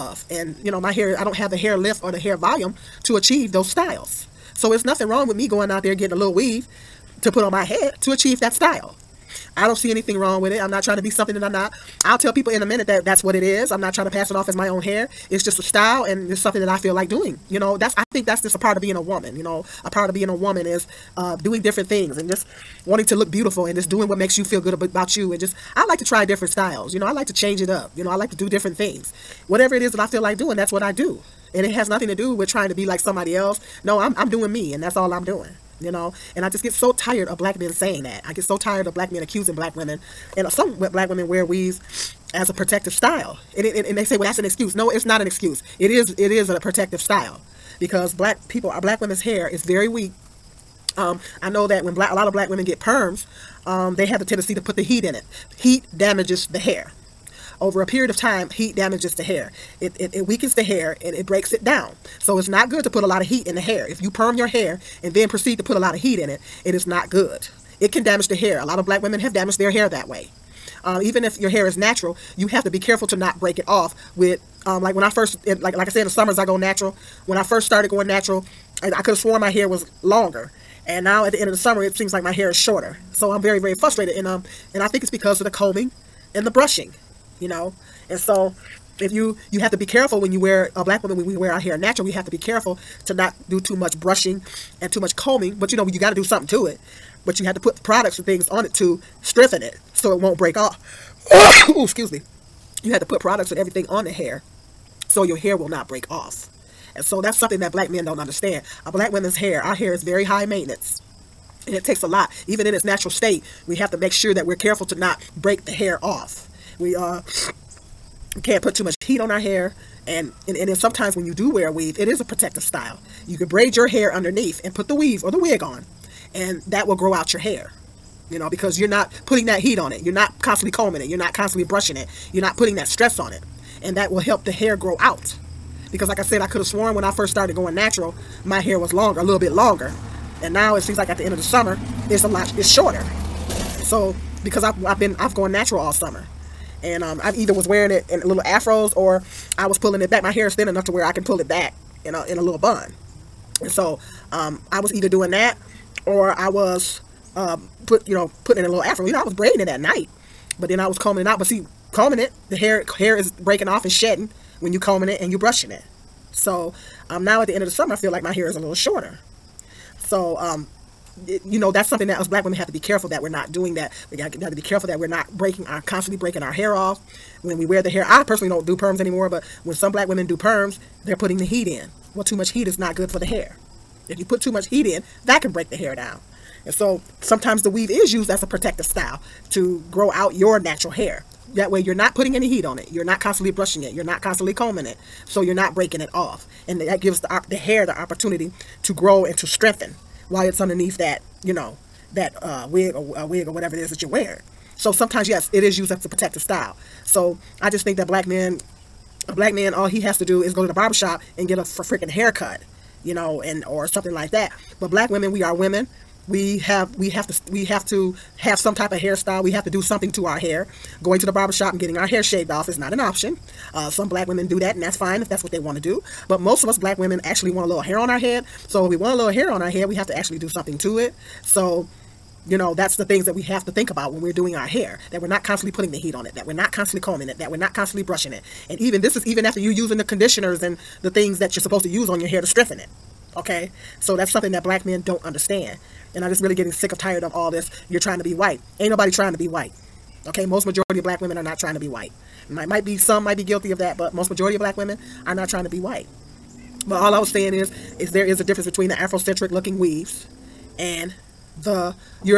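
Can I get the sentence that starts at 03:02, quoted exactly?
Well, too much heat is not good for the hair.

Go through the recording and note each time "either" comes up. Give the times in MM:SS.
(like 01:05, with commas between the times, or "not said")
02:27, 02:34.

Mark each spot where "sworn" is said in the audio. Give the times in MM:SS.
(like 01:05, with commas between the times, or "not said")
01:19, 02:16.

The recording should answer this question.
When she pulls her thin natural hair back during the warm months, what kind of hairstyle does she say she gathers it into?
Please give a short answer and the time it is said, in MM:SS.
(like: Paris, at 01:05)
little bun, at 02:32.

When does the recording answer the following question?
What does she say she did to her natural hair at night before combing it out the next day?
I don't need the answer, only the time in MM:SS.
02:39.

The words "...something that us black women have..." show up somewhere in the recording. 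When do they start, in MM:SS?
02:51.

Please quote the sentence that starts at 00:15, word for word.
It's just a style and it's something that I feel like doing.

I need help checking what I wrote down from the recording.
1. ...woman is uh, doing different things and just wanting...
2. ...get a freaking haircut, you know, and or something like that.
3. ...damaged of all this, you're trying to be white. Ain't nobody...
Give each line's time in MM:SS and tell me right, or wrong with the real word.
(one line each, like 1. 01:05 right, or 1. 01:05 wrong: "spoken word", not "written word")
1. 00:20 right
2. 03:31 right
3. 04:06 wrong: "tired", not "damaged".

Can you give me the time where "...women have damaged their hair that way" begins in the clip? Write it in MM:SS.
01:09.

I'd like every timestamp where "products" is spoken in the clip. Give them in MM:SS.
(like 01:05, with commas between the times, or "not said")
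01:37, 01:43.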